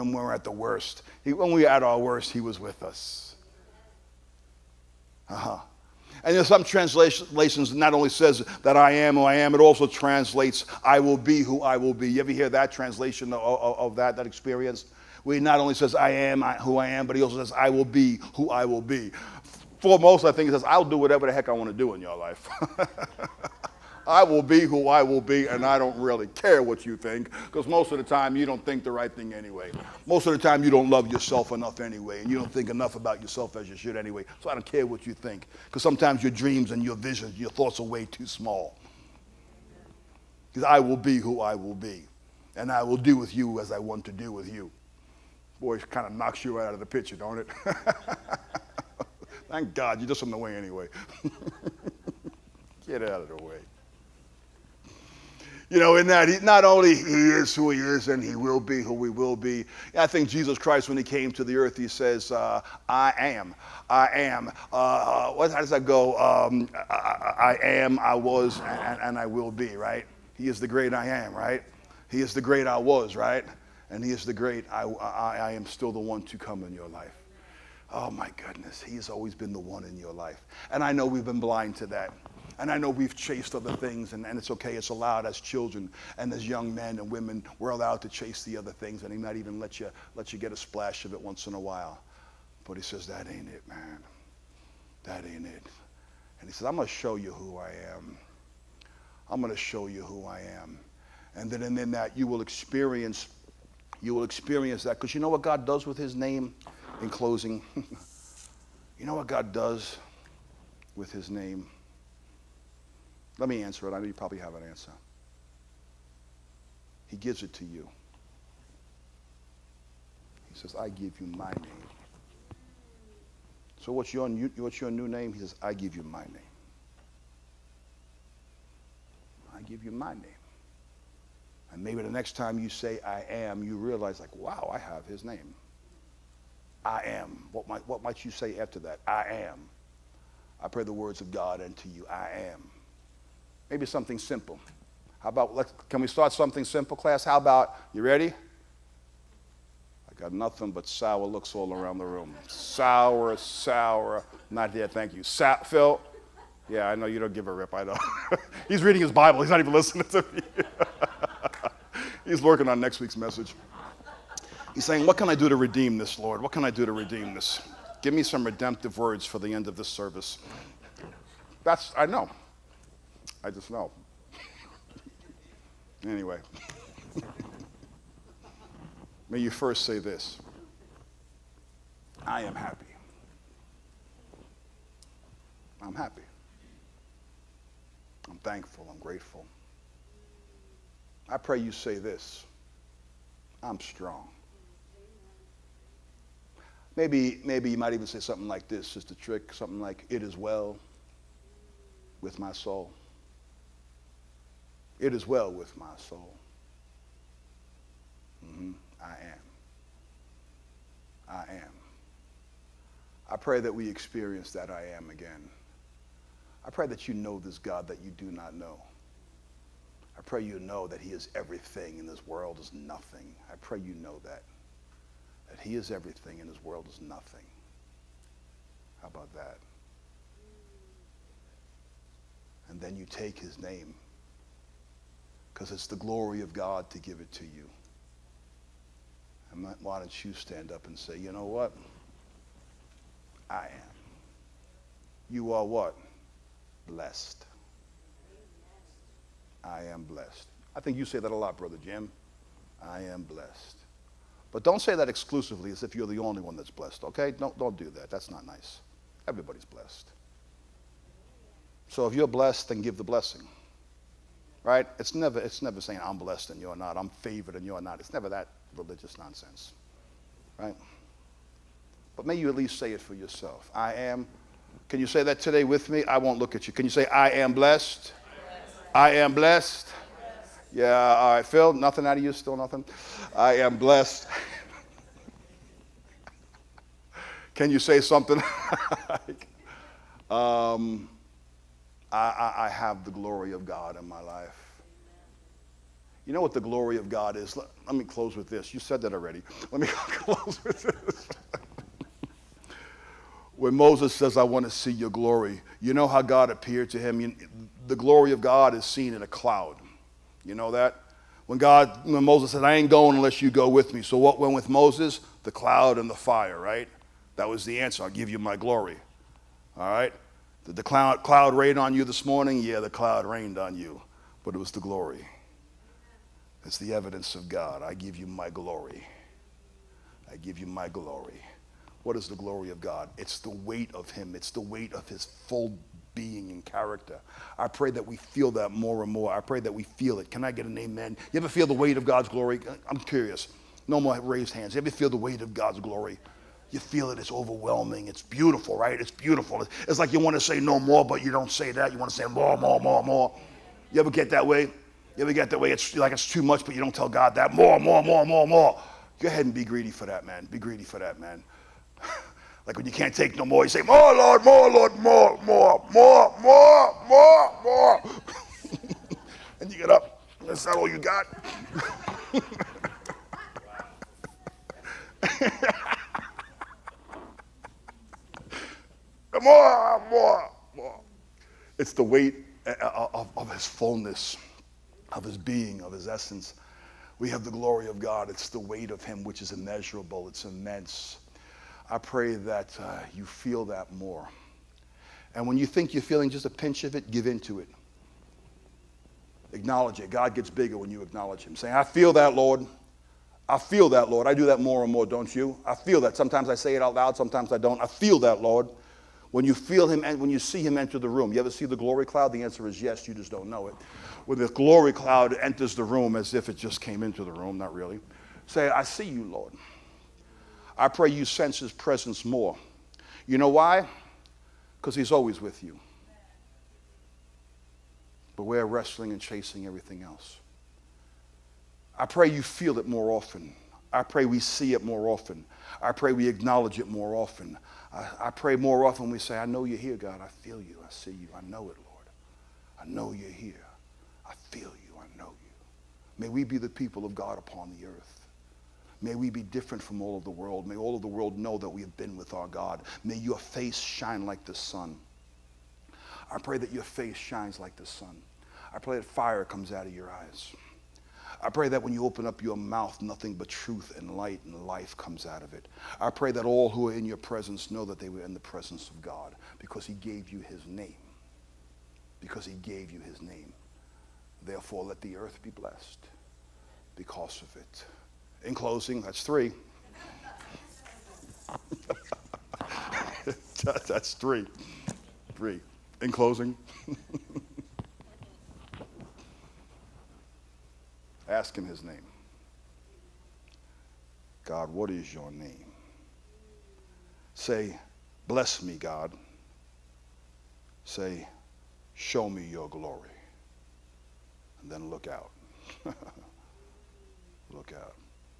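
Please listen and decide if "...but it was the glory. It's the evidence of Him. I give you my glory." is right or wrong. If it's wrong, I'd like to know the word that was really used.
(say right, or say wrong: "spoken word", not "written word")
wrong: "God", not "Him".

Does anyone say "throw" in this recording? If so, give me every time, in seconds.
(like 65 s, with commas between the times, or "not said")
not said.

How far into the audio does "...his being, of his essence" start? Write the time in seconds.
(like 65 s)
385 s.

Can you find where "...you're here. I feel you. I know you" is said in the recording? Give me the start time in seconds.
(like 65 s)
443 s.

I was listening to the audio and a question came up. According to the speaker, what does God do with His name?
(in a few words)
He gives it to you.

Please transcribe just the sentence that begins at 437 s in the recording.
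I, I, pray more often we say, I know you're here, God.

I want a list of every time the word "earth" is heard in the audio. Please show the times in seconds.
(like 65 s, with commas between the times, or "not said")
61 s, 447 s, 475 s.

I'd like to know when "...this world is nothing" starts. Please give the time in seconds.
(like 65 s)
222 s.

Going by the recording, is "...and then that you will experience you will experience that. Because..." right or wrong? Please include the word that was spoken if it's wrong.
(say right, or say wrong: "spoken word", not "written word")
right.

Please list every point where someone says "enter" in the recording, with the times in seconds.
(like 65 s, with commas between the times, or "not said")
410 s, 415 s.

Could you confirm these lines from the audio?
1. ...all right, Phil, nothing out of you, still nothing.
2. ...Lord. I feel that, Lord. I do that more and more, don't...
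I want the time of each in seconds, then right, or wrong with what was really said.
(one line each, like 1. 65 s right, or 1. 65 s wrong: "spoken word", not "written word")
1. 281 s right
2. 402 s right.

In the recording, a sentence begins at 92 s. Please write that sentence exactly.
But He says, That ain't it, man.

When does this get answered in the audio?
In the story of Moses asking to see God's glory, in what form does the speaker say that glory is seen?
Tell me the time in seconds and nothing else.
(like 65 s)
309 s.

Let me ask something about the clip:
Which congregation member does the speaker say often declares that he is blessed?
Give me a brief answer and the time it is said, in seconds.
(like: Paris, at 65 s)
Brother Jim, at 251 s.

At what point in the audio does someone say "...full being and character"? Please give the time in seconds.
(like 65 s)
335 s.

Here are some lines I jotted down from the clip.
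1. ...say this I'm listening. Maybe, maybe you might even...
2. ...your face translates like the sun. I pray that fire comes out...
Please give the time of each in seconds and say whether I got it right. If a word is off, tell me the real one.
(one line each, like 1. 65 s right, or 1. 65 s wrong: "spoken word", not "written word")
1. 191 s wrong: "strong", not "listening"
2. 456 s wrong: "shines", not "translates".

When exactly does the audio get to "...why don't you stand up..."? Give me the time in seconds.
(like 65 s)
239 s.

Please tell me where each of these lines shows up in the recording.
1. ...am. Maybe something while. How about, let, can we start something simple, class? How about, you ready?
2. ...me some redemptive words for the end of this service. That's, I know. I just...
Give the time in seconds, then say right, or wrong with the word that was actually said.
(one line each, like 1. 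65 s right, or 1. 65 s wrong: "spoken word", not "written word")
1. 142 s wrong: "simple", not "while"
2. 168 s right.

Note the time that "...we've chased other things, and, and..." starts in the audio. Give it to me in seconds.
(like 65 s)
82 s.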